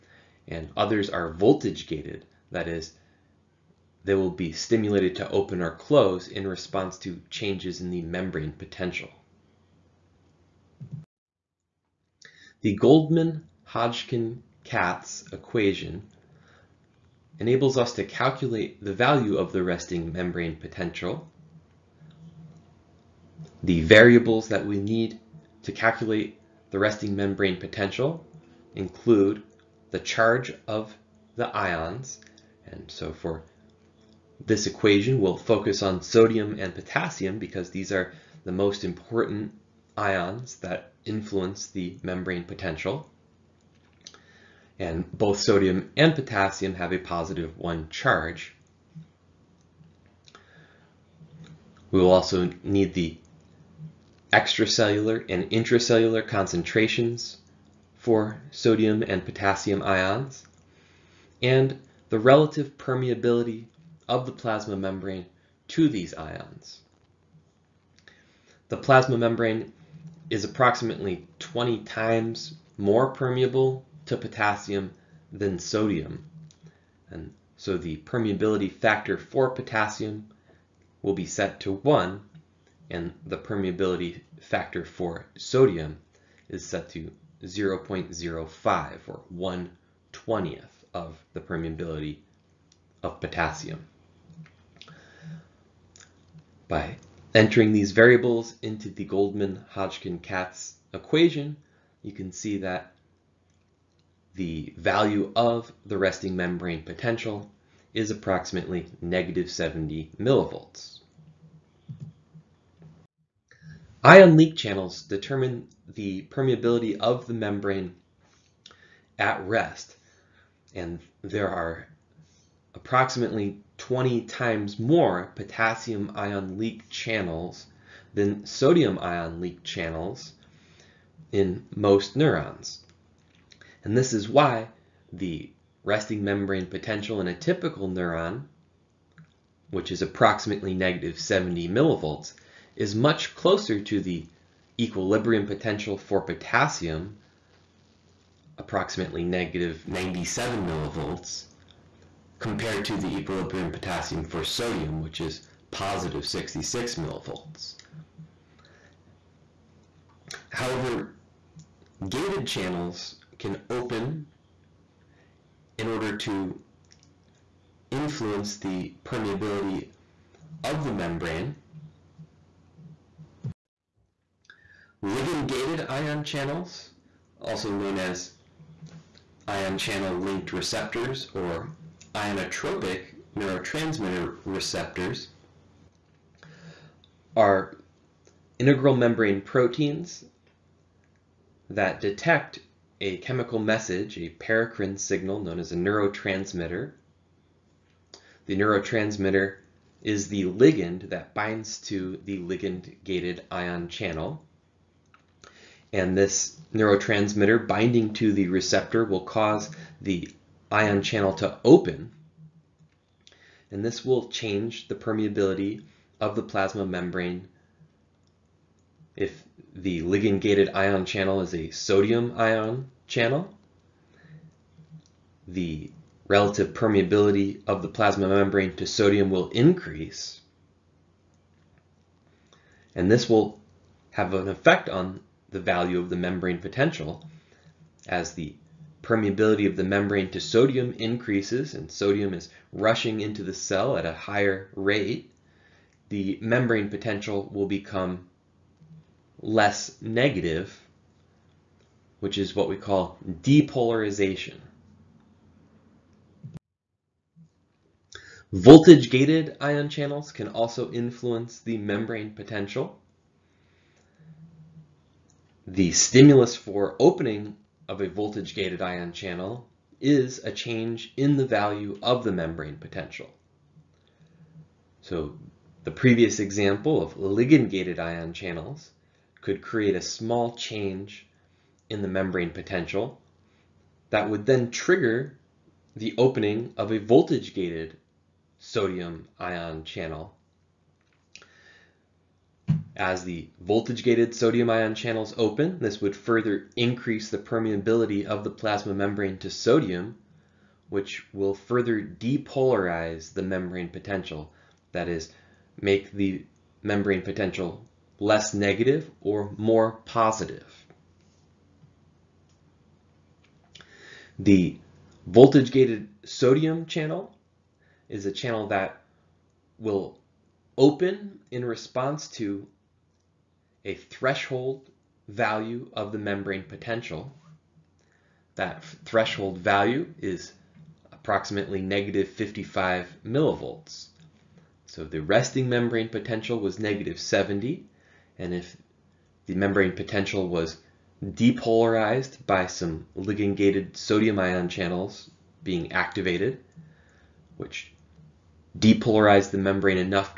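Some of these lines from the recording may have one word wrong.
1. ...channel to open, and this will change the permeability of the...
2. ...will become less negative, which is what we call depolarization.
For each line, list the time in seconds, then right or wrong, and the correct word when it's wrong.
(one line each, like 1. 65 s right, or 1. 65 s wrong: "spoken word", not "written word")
1. 211 s right
2. 247 s right.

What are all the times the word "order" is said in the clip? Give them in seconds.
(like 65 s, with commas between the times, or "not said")
165 s.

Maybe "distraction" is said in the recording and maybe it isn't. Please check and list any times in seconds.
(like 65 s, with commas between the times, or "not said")
not said.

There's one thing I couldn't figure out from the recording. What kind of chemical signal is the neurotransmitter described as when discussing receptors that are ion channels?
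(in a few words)
paracrine signal.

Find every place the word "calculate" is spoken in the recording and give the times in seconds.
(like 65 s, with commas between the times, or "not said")
18 s, 25 s.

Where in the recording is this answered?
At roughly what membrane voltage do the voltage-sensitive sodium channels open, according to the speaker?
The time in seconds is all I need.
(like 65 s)
331 s.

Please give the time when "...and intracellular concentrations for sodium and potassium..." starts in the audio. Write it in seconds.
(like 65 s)
55 s.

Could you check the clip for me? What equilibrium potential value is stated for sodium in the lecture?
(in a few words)
+66 millivolts.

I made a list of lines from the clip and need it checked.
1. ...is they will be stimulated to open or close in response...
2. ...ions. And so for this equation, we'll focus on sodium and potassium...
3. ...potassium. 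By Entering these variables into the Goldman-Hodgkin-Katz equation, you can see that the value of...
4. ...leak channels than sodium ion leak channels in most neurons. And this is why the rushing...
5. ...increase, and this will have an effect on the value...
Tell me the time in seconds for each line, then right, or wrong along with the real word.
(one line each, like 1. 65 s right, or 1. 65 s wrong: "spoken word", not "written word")
1. 2 s right
2. 31 s right
3. 93 s right
4. 126 s wrong: "resting", not "rushing"
5. 229 s right.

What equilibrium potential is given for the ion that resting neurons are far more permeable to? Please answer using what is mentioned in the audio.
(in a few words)
-97 millivolts.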